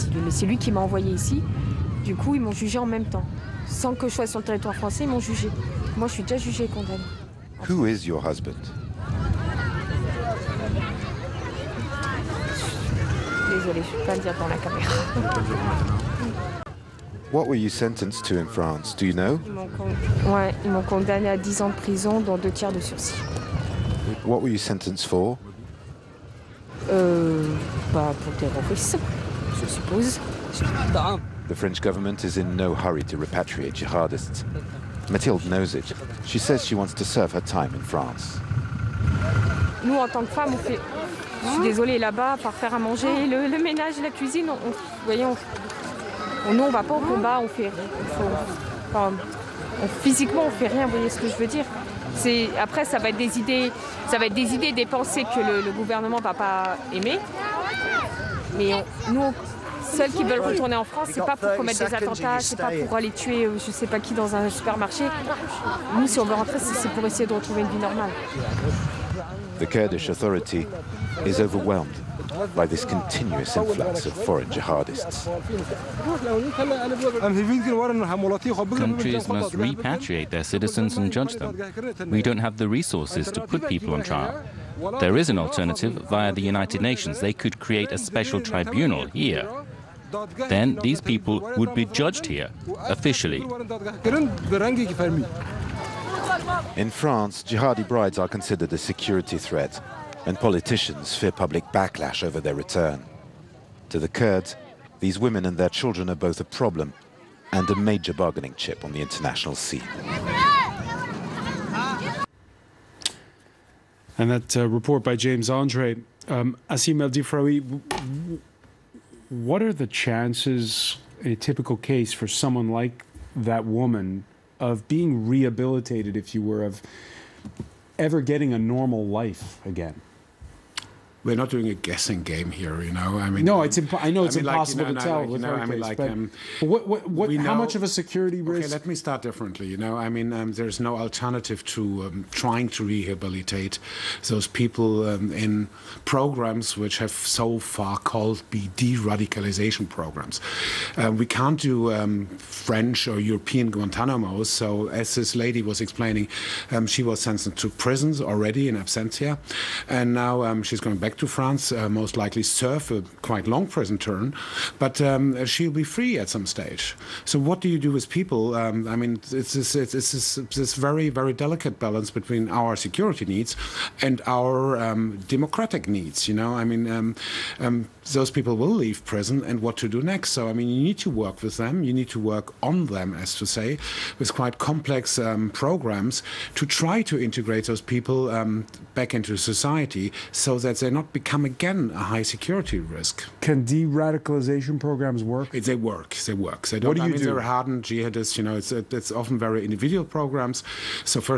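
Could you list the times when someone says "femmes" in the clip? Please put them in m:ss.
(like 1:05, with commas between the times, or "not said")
0:40.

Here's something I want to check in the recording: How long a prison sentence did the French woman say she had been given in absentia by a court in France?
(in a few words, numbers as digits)
10 years.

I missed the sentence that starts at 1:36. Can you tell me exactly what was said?
In France, jihadi brides are considered a security threat, and politicians fear public backlash over their return.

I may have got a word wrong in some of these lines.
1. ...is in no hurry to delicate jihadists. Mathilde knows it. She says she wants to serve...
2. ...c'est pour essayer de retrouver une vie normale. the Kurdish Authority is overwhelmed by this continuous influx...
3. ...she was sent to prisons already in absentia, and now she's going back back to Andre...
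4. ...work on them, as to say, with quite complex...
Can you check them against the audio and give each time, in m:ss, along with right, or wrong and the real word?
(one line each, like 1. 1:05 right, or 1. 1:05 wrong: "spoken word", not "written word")
1. 0:32 wrong: "repatriate", not "delicate"
2. 1:06 right
3. 2:36 wrong: "France", not "Andre"
4. 3:02 right.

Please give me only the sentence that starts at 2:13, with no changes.
I mean, no, it's impo- I know it's mean, impossible like, you know, to no, tell.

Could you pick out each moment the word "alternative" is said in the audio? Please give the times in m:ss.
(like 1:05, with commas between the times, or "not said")
1:25, 2:20.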